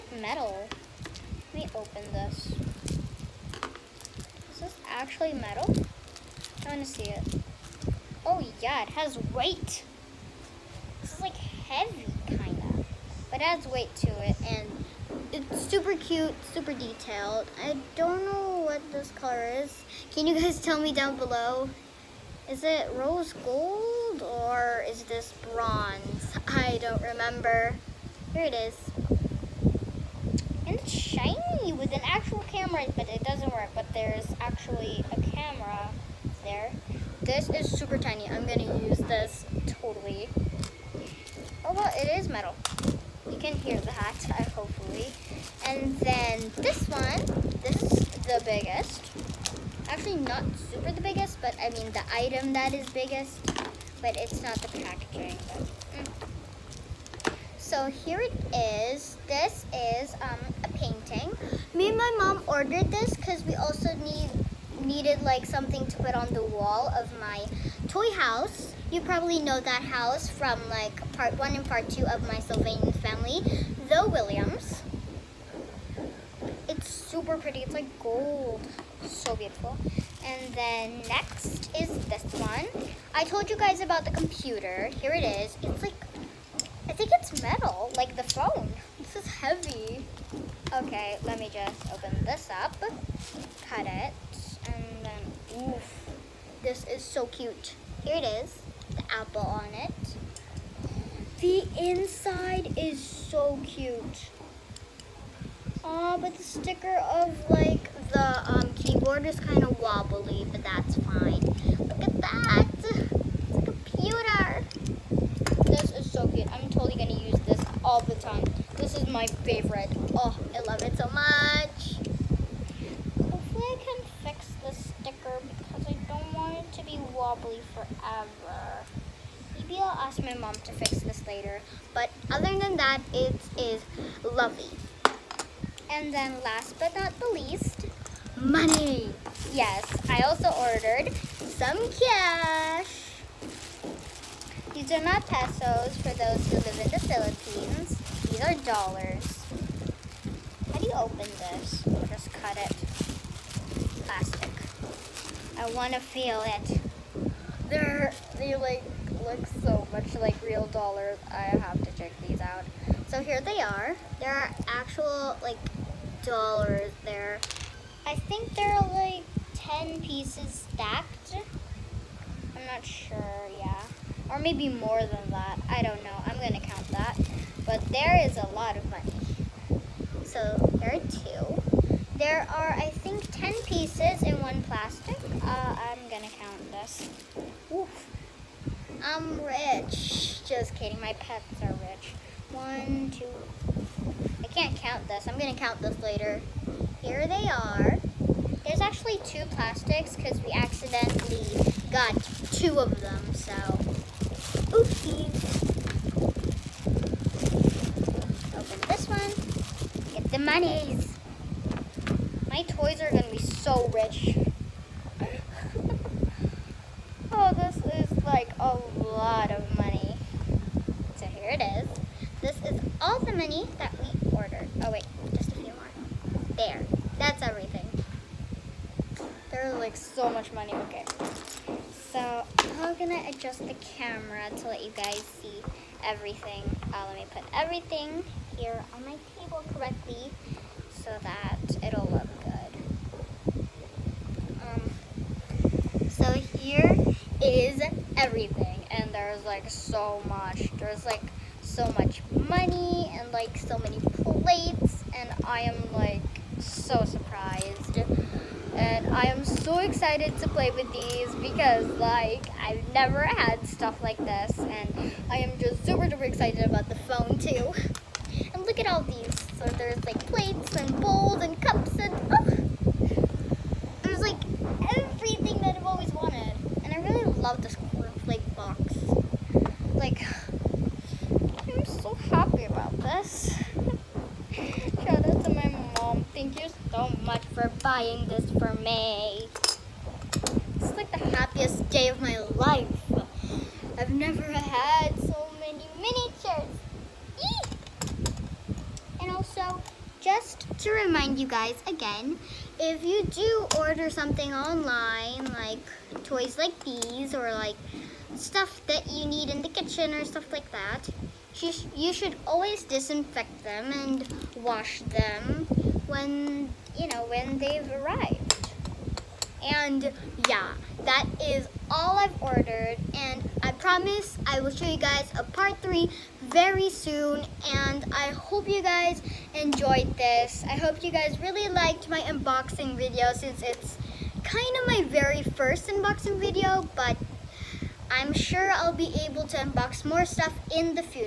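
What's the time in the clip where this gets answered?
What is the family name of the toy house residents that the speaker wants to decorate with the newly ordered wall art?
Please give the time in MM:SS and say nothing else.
01:13.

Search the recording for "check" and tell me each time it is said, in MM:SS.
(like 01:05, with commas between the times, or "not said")
02:41.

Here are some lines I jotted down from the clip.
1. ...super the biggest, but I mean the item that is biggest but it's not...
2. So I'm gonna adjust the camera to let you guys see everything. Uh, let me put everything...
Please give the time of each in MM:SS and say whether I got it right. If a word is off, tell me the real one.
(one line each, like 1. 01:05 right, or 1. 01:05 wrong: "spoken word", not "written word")
1. 00:50 right
2. 03:52 right.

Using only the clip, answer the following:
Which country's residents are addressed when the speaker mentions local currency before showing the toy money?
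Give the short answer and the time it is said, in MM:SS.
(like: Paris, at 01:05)
Philippines, at 02:27.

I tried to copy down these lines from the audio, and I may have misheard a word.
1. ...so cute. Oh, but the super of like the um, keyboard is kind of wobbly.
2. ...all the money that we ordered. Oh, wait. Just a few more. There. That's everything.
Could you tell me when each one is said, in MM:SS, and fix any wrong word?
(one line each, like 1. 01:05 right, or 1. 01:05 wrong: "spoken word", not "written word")
1. 01:43 wrong: "sticker", not "super"
2. 03:43 right.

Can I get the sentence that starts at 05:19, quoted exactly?
And yeah, that is all I've ordered.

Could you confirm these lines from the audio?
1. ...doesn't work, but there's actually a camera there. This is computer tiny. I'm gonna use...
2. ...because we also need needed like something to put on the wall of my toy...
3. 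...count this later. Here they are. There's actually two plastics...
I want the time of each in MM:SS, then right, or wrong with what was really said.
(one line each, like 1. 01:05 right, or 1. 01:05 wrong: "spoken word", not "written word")
1. 00:33 wrong: "super", not "computer"
2. 01:03 right
3. 03:15 right.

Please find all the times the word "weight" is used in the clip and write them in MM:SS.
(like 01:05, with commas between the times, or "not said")
00:09, 00:13.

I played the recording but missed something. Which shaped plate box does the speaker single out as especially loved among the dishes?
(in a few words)
Corn.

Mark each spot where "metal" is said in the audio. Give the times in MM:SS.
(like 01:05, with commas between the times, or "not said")
00:00, 00:05, 00:42, 01:27.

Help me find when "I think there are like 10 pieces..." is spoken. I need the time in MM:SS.
02:48.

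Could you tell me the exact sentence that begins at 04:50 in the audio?
It's like the happiest day of my life.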